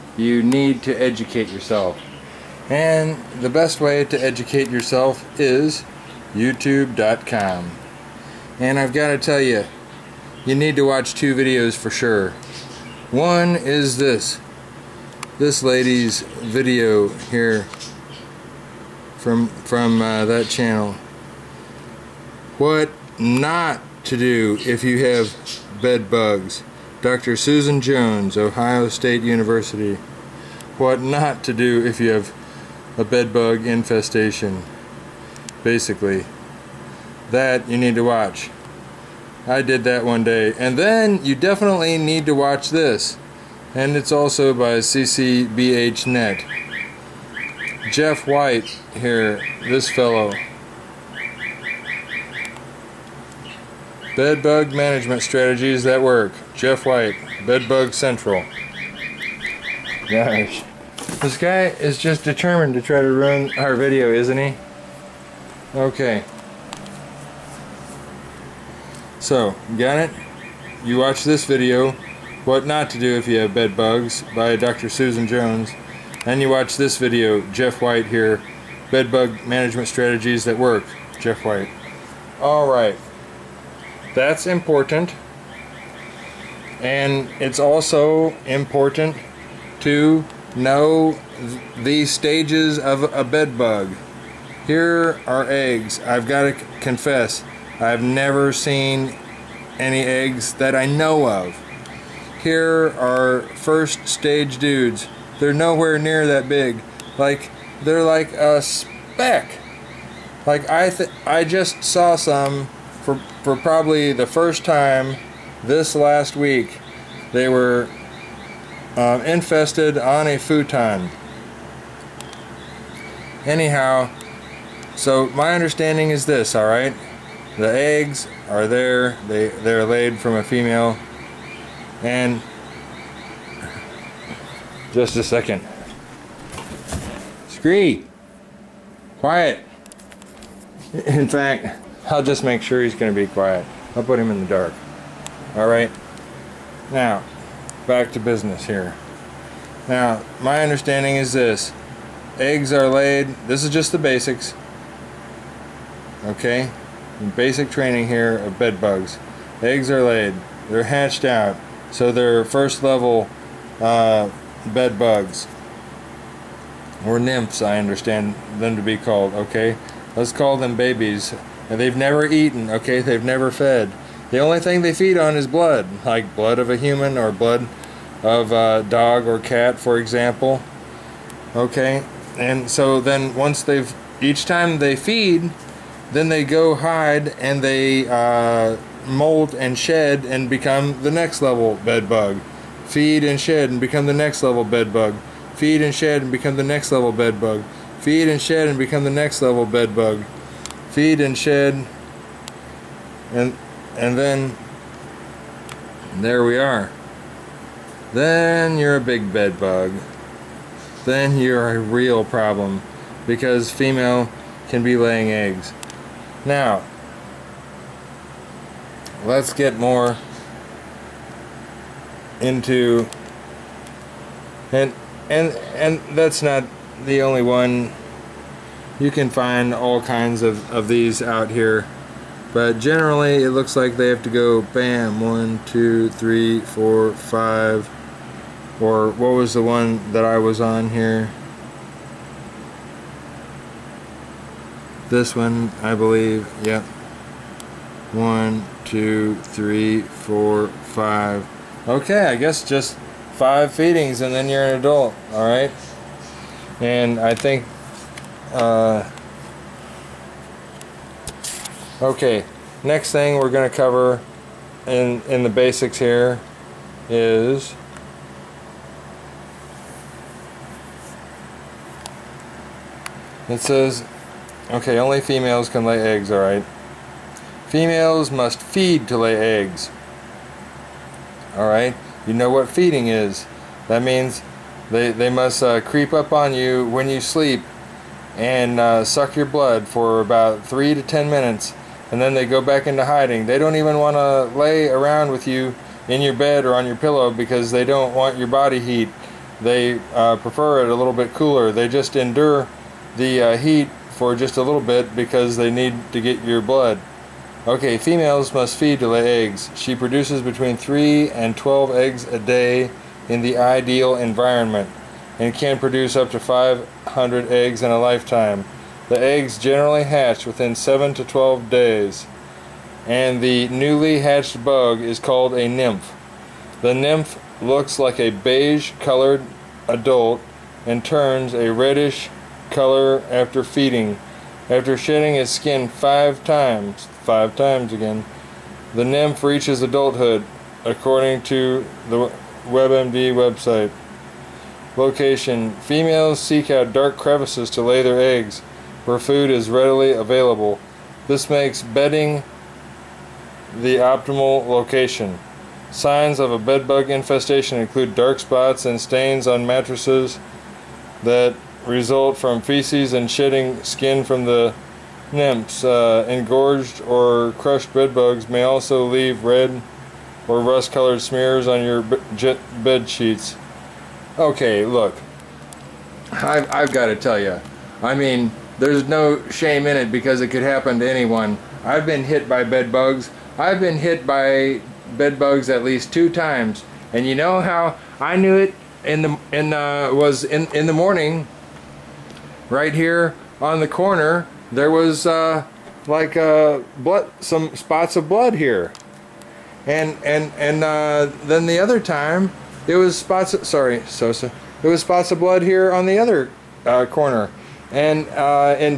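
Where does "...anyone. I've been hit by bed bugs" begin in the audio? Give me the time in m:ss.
6:21.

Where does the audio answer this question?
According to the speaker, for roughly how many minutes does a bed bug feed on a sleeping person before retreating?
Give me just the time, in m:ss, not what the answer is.
4:50.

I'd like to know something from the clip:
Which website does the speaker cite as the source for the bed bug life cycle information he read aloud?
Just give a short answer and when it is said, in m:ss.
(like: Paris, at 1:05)
WebMD, at 5:42.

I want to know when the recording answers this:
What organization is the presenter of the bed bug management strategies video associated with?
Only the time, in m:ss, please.
0:57.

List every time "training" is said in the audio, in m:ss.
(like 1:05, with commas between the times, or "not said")
2:37.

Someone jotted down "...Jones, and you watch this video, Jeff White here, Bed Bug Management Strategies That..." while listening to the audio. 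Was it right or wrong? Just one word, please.
right.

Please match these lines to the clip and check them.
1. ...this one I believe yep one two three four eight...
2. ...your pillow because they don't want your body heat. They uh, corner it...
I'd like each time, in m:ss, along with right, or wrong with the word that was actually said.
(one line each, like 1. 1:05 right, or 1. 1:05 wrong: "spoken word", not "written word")
1. 4:05 wrong: "five", not "eight"
2. 4:56 wrong: "prefer", not "corner".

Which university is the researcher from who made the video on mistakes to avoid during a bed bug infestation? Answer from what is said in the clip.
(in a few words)
Ohio State University.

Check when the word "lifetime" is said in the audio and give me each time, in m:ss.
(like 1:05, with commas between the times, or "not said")
5:17.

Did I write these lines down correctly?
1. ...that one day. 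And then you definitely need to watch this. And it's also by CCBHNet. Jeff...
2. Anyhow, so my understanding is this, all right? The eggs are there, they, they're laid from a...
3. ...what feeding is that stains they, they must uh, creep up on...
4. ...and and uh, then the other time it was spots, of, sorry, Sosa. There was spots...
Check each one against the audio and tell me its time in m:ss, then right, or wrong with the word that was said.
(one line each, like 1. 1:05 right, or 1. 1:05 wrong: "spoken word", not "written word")
1. 0:39 right
2. 2:03 right
3. 4:42 wrong: "means", not "stains"
4. 6:40 right.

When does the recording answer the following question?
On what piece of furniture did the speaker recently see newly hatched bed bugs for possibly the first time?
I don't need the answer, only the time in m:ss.
2:00.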